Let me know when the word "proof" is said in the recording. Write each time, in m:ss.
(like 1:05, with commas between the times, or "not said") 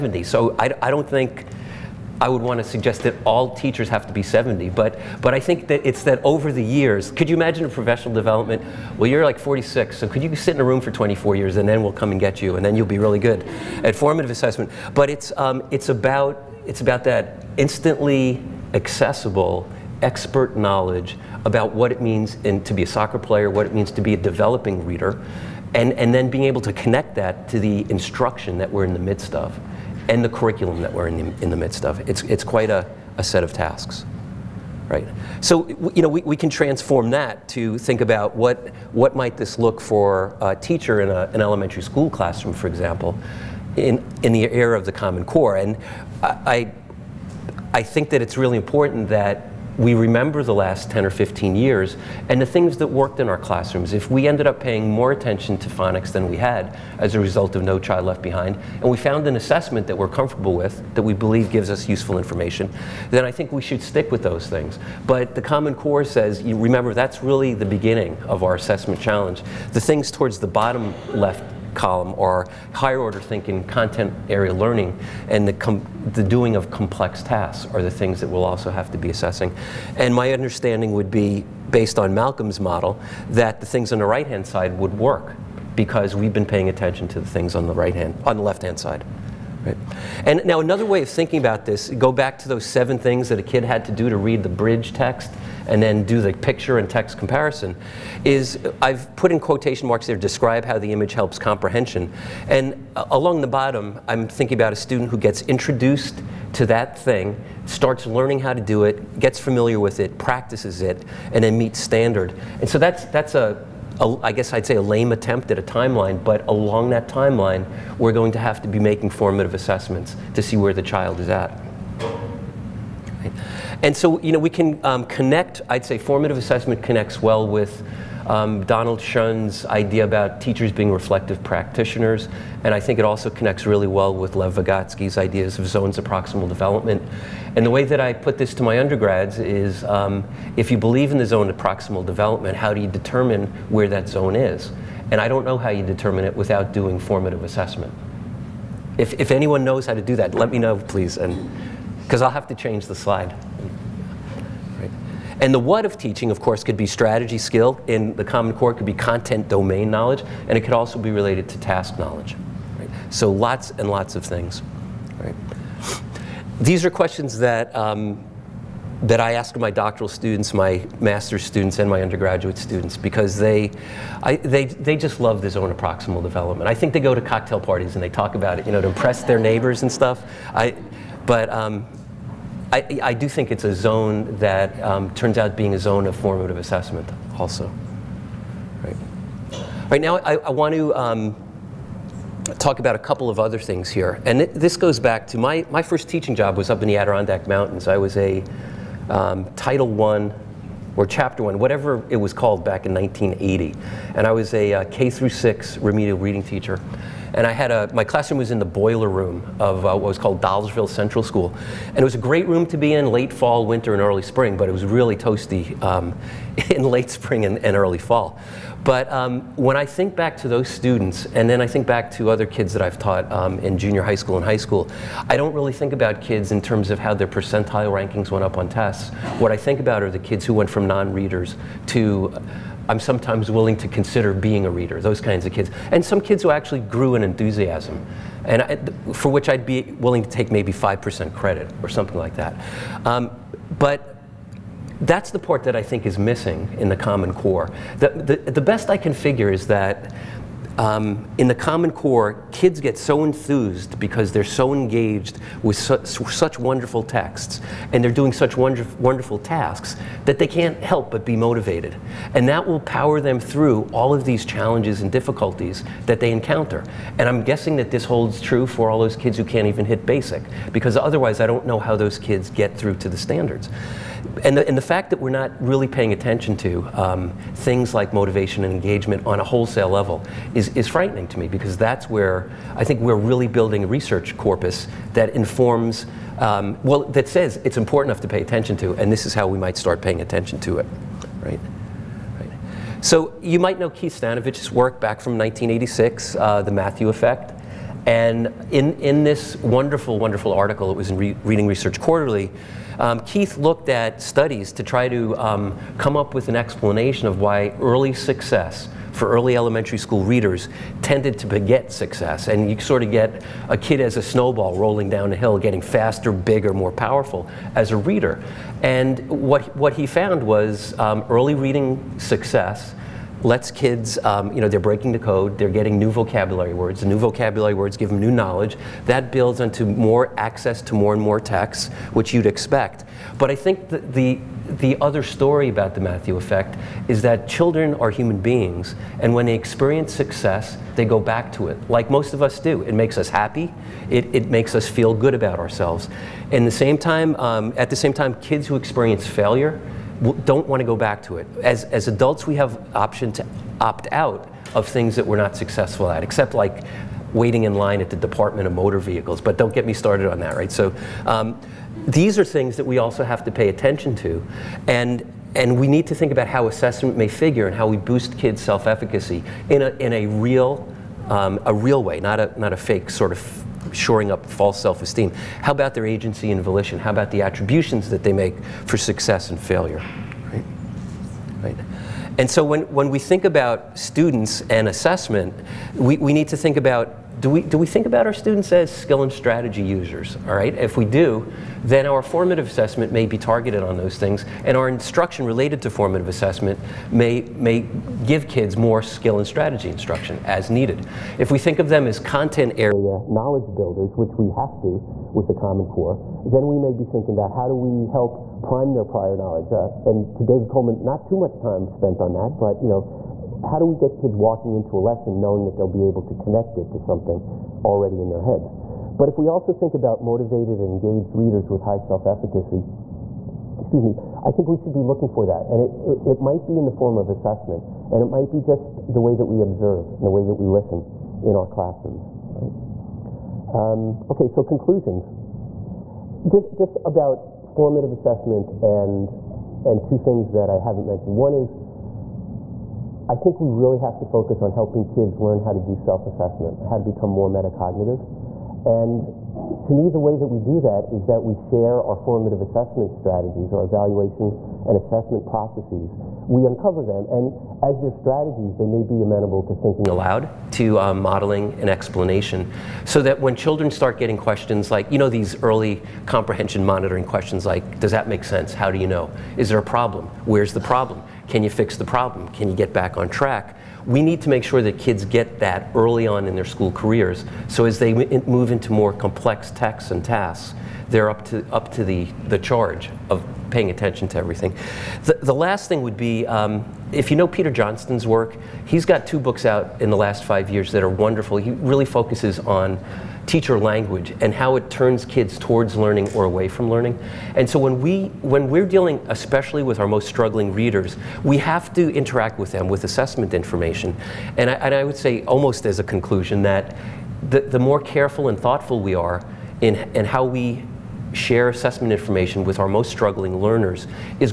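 not said.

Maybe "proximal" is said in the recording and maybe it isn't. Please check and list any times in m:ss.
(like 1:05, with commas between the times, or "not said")
2:16, 2:21, 2:55.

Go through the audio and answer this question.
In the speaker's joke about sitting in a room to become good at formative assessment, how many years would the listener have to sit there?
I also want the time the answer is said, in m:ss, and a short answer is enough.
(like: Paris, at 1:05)
24, at 0:10.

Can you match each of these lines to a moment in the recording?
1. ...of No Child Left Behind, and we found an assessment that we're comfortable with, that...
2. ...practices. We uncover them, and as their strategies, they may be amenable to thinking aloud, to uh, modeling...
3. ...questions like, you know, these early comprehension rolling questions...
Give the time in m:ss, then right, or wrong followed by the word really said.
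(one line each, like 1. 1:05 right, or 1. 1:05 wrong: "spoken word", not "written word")
1. 0:57 right
2. 7:35 wrong: "processes", not "practices"
3. 7:44 wrong: "monitoring", not "rolling".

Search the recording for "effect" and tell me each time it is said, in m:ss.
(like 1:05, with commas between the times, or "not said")
4:57, 5:36.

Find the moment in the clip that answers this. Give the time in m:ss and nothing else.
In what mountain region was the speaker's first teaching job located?
3:16.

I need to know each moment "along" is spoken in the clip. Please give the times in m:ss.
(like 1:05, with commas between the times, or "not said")
1:43, 1:56.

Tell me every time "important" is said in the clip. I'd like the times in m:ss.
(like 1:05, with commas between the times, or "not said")
0:48, 4:47.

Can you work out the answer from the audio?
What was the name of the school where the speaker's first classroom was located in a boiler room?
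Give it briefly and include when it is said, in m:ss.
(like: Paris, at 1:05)
Dolgeville Central School, at 3:30.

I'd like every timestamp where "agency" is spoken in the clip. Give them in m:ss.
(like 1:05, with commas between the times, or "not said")
6:16.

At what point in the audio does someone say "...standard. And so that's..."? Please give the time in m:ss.
1:51.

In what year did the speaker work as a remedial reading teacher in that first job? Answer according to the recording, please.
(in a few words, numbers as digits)
1980.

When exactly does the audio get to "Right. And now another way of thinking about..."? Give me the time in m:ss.
1:29.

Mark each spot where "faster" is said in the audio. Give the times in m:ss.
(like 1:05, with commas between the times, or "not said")
5:15.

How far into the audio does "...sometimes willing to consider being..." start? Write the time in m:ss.
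3:52.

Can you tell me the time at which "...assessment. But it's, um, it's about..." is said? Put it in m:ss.
0:14.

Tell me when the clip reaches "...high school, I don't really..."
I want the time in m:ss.
3:44.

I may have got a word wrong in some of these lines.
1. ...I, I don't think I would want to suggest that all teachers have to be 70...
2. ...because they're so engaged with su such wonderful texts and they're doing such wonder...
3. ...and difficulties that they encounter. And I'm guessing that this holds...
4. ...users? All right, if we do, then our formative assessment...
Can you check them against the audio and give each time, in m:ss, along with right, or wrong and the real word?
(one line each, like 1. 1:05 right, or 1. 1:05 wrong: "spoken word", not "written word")
1. 0:00 right
2. 4:13 right
3. 4:25 right
4. 6:29 right.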